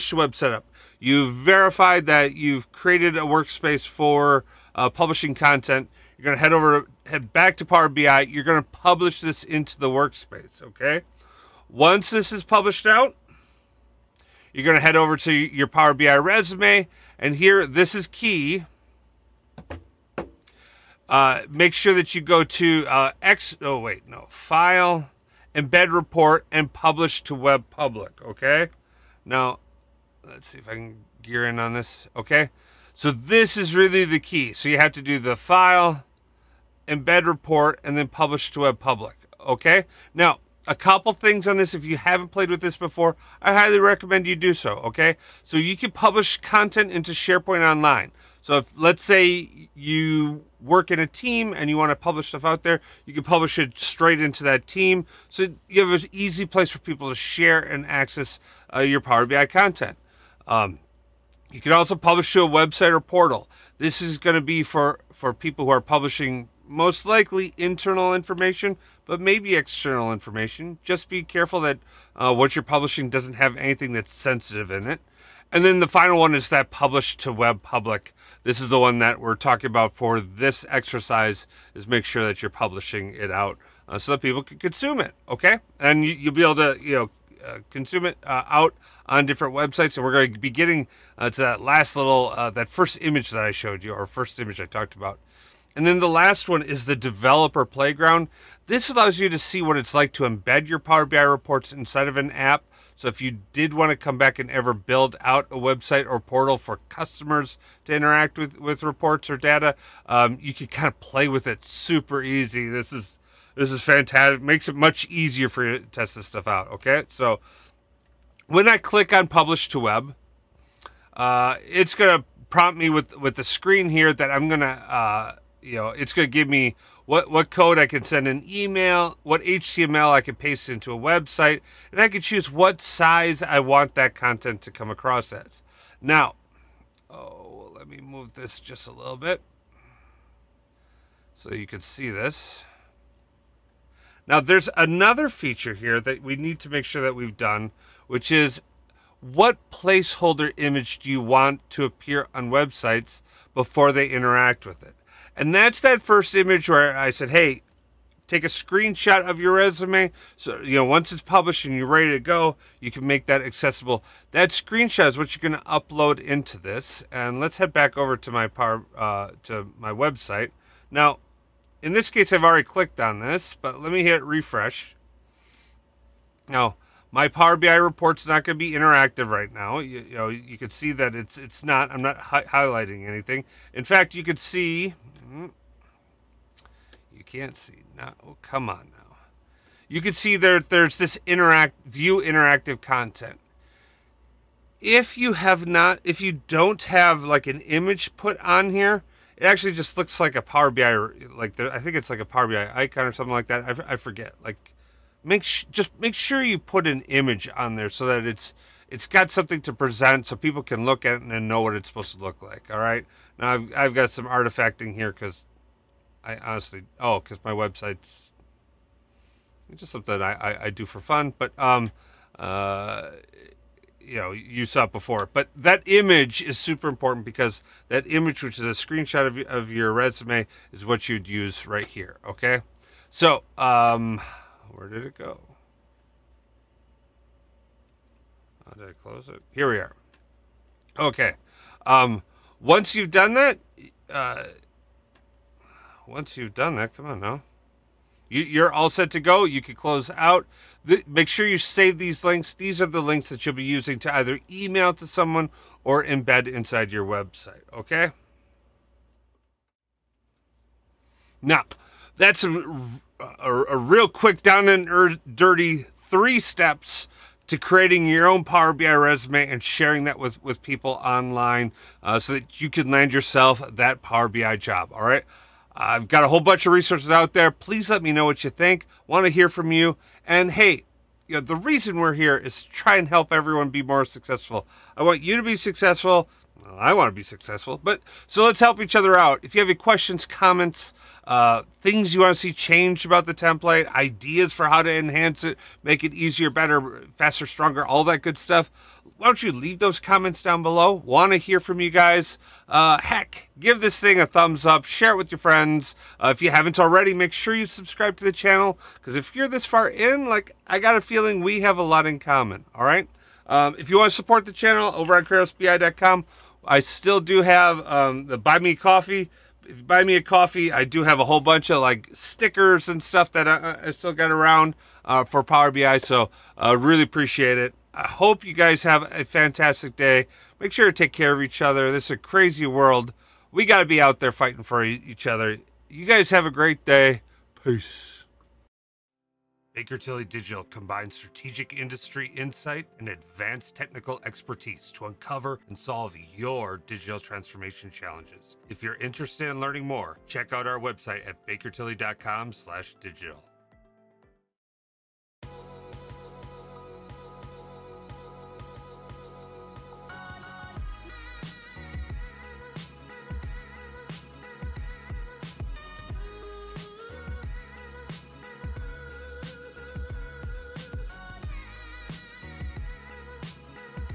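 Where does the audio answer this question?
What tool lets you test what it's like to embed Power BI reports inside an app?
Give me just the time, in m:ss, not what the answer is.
1:36.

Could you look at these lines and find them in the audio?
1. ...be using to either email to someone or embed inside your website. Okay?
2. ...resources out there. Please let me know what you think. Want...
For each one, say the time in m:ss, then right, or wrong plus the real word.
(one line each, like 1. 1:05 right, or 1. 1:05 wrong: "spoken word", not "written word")
1. 4:13 right
2. 4:36 right.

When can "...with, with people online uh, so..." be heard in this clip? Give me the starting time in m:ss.
4:30.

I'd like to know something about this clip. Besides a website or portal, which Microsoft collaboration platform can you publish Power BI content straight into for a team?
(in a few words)
SharePoint Online.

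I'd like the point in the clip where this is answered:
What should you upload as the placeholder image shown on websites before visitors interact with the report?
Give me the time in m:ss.
2:38.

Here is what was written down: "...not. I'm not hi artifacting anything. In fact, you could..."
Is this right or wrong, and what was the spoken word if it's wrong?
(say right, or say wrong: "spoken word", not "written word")
wrong: "highlighting", not "artifacting".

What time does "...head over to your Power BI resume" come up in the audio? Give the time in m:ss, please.
0:14.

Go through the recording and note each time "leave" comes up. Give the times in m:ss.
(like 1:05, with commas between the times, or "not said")
4:59.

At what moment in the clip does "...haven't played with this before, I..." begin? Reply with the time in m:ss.
0:41.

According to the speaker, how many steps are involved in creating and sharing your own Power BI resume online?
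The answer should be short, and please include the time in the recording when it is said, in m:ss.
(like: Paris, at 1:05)
3, at 4:26.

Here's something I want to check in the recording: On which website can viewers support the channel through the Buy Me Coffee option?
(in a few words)
KratosBI.com.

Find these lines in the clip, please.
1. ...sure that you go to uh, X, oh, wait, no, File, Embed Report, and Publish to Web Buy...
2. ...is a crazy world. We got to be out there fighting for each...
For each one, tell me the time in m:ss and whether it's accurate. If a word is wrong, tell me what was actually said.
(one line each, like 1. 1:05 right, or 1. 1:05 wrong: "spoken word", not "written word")
1. 0:21 wrong: "Public", not "Buy"
2. 5:32 right.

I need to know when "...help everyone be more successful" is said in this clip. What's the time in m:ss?
4:43.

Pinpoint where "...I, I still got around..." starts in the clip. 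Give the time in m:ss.
5:23.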